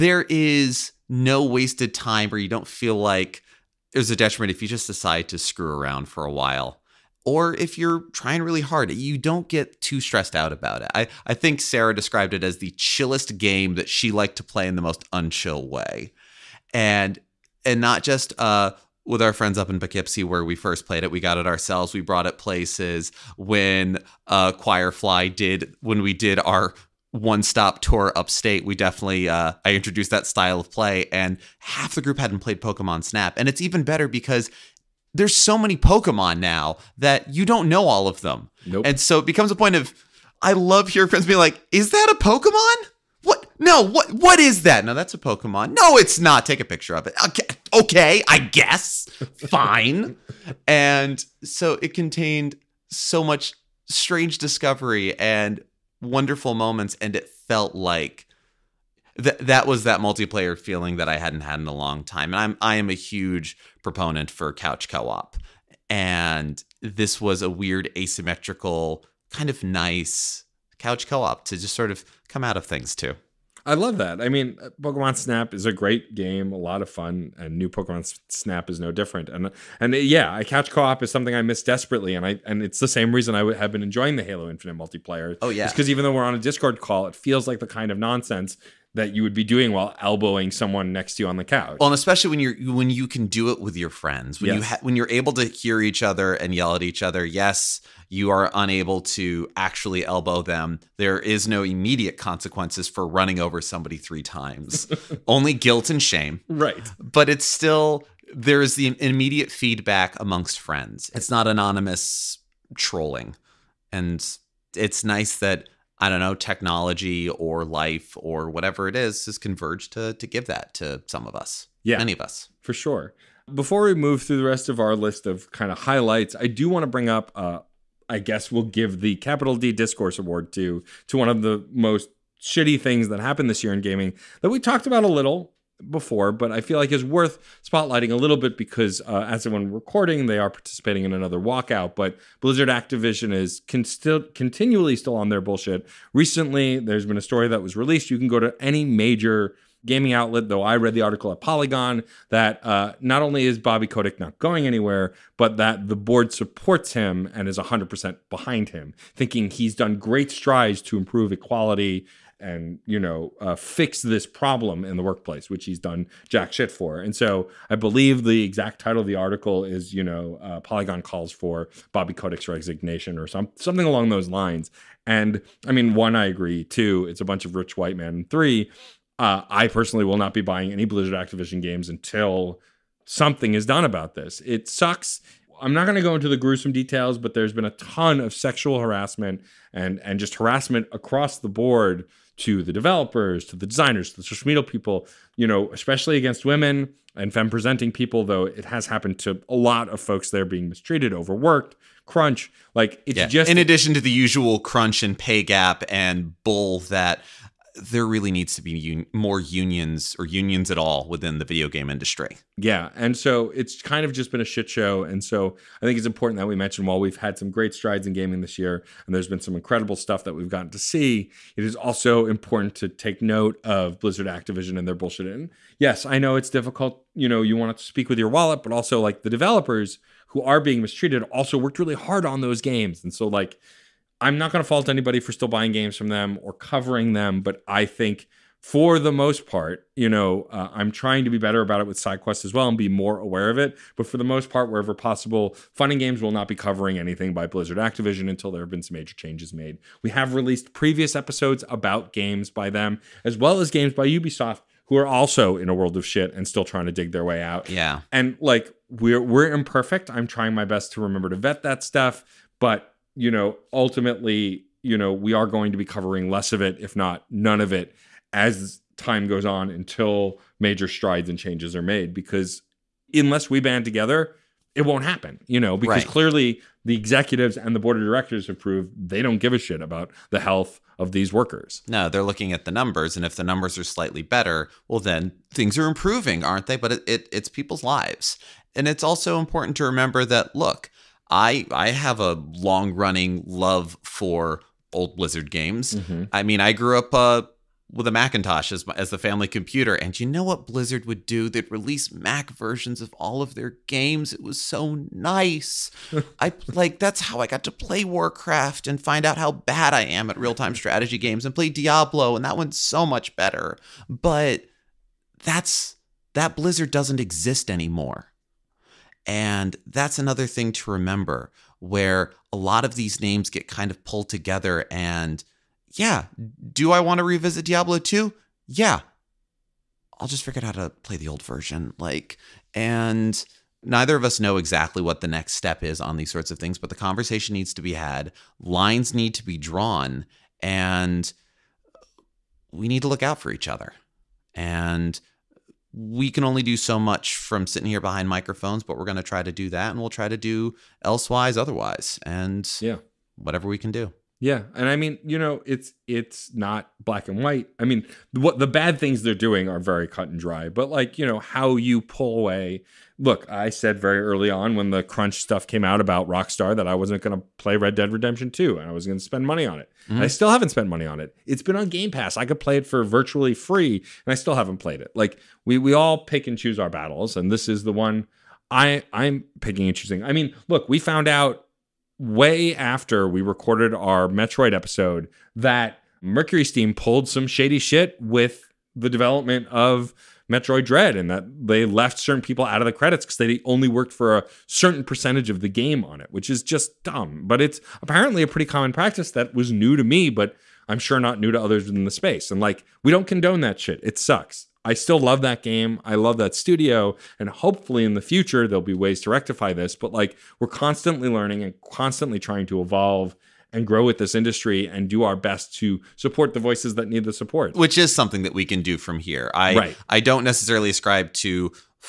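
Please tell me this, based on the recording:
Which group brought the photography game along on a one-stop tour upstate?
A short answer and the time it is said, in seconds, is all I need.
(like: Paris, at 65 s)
Choirfly, at 24 s.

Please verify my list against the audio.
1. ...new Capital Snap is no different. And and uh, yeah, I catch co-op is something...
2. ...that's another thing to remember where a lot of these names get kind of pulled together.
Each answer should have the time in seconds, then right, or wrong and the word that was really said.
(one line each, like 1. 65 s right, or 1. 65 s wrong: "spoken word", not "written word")
1. 77 s wrong: "Pokemon", not "Capital"
2. 319 s right.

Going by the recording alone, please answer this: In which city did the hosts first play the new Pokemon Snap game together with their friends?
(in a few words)
Poughkeepsie.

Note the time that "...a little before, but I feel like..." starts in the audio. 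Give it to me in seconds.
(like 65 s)
135 s.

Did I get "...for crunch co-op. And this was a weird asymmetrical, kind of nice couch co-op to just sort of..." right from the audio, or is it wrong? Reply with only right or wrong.
wrong.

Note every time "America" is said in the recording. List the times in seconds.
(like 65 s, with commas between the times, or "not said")
not said.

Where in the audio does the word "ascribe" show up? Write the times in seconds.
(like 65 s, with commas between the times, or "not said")
420 s.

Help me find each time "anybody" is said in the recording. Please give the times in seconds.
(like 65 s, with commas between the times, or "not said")
234 s.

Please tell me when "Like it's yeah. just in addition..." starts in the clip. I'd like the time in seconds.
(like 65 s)
202 s.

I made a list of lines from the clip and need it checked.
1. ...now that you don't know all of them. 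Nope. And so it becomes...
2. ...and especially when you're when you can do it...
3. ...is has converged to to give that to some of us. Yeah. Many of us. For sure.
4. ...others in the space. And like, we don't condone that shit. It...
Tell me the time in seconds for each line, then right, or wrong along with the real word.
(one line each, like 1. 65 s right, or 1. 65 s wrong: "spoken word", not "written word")
1. 36 s right
2. 91 s right
3. 118 s right
4. 401 s right.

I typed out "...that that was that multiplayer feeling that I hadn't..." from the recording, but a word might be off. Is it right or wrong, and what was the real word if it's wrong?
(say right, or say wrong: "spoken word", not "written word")
right.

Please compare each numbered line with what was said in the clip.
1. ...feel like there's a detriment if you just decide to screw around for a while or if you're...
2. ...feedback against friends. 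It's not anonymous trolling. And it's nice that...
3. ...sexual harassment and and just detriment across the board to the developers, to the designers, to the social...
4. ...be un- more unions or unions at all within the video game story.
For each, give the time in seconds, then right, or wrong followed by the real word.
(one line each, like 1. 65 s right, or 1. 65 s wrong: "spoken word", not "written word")
1. 2 s right
2. 109 s wrong: "amongst", not "against"
3. 188 s wrong: "harassment", not "detriment"
4. 208 s wrong: "industry", not "story".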